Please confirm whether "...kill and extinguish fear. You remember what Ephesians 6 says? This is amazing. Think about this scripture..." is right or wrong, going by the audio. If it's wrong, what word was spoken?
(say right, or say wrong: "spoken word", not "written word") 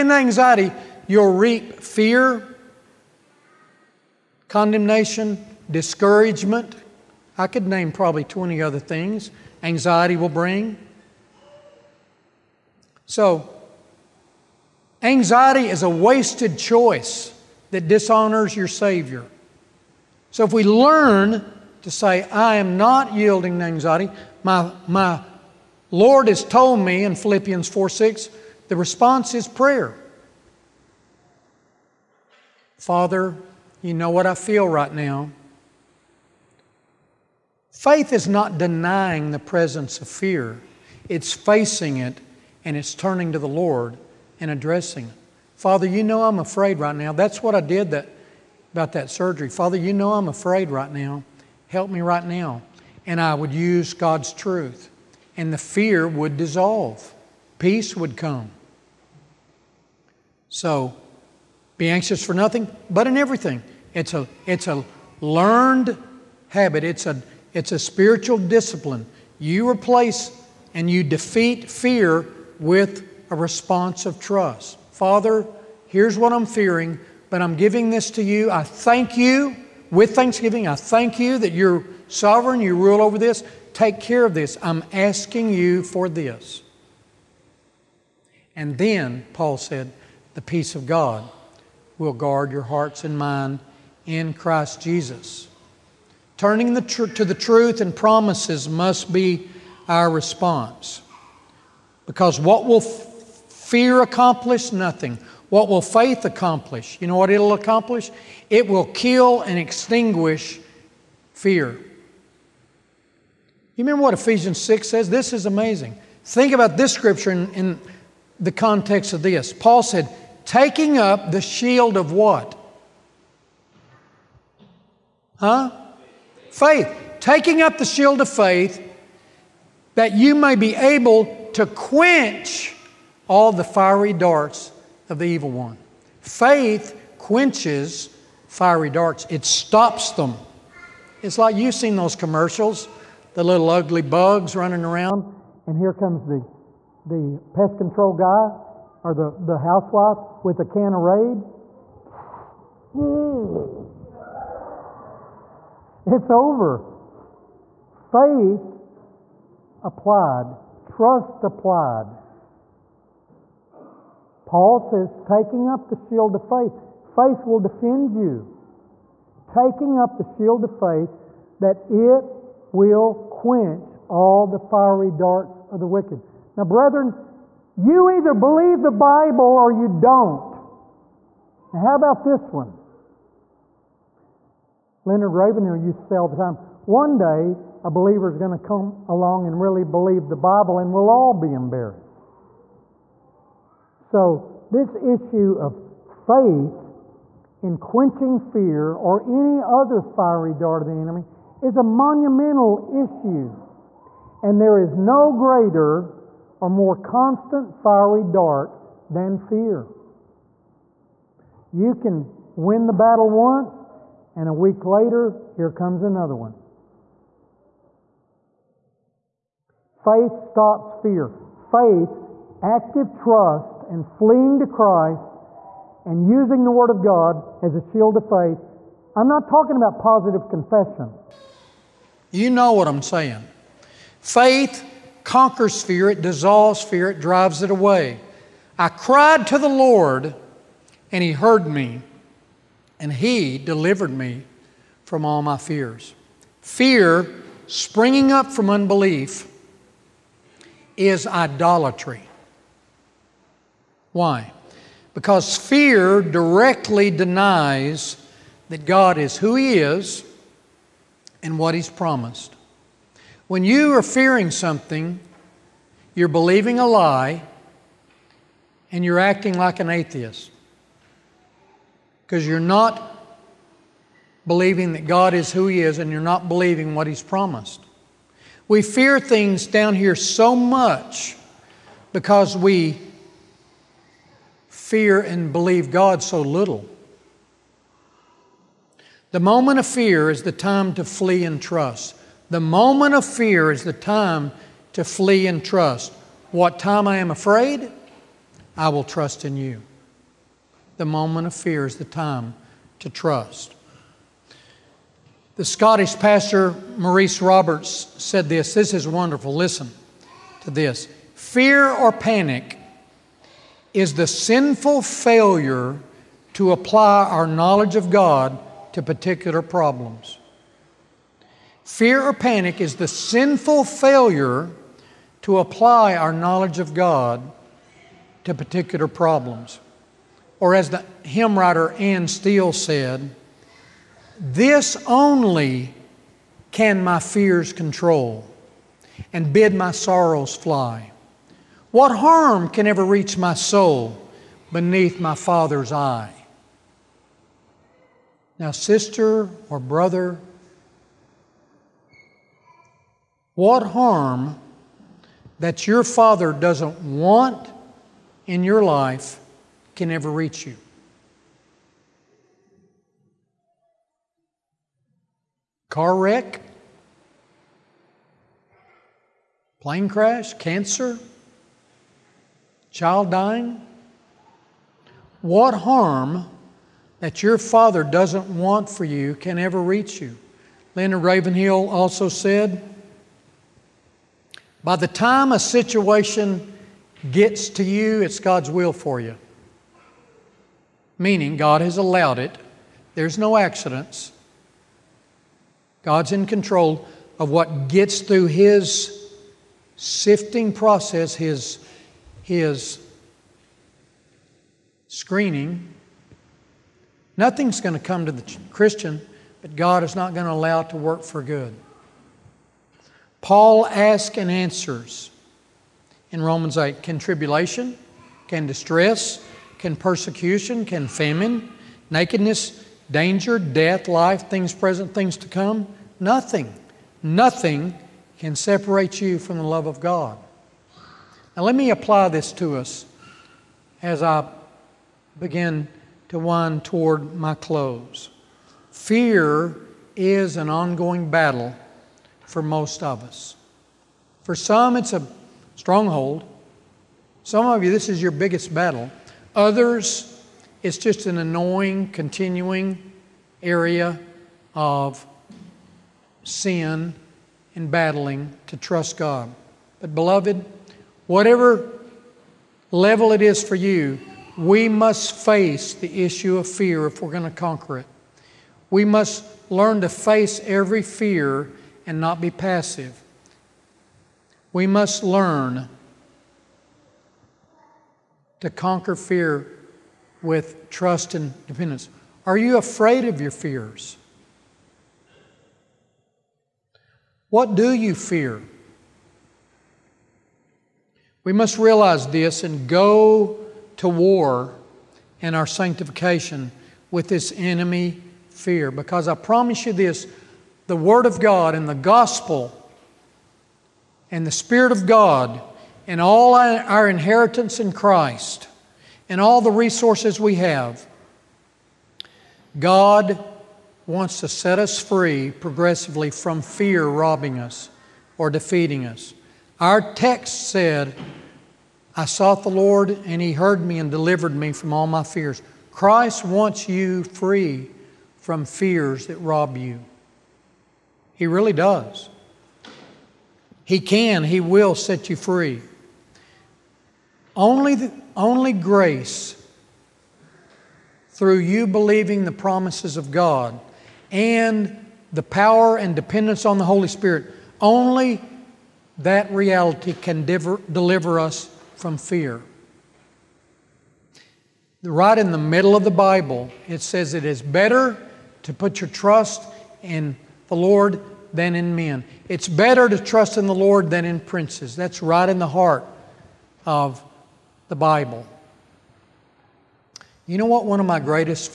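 right.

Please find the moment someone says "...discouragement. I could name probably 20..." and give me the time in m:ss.
0:05.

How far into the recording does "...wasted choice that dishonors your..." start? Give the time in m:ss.
0:15.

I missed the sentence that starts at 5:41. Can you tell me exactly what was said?
What harm can ever reach my soul beneath my Father's eye?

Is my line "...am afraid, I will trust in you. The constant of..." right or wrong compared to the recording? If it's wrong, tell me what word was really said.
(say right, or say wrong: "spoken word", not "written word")
wrong: "moment", not "constant".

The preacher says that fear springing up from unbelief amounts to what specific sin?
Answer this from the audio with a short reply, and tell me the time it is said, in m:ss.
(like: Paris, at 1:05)
idolatry, at 4:11.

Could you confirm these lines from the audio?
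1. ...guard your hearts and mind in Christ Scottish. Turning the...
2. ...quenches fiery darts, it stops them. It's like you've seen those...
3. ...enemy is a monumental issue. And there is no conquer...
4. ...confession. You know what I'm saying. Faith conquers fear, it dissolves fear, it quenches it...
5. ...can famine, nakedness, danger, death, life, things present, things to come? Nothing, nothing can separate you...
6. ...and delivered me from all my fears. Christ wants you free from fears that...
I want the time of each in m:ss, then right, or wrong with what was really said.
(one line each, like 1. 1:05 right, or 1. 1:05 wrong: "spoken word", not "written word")
1. 1:32 wrong: "Jesus", not "Scottish"
2. 2:17 right
3. 3:20 wrong: "greater", not "conquer"
4. 3:50 wrong: "drives", not "quenches"
5. 7:00 right
6. 8:43 right.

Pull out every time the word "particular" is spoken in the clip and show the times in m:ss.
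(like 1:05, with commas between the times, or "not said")
5:19, 5:28.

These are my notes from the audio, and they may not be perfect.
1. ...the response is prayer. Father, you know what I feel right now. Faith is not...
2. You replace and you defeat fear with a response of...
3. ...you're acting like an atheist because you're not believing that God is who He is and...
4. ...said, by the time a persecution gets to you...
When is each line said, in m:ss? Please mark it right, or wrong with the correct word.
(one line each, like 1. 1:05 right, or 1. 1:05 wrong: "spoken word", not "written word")
1. 0:28 right
2. 1:09 right
3. 4:29 right
4. 6:22 wrong: "situation", not "persecution".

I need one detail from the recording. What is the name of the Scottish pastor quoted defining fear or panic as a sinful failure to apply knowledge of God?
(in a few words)
Maurice Roberts.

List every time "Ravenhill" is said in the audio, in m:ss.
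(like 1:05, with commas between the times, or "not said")
3:05, 6:21.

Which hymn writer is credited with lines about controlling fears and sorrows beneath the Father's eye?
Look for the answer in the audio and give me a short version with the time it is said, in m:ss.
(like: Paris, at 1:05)
Anne Steele, at 5:31.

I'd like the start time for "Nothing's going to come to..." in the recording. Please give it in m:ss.
6:47.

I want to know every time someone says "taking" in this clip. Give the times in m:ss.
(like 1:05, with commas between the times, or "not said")
2:00, 2:07, 2:45, 2:49.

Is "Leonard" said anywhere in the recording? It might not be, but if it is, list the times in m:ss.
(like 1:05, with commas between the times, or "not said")
3:05, 6:20.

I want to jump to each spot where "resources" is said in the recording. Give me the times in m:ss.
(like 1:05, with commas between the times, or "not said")
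8:29.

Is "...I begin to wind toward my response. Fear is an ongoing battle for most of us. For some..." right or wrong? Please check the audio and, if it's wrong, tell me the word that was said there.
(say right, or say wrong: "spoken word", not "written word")
wrong: "close", not "response".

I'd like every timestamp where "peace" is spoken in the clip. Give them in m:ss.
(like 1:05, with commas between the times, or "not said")
0:57, 1:30.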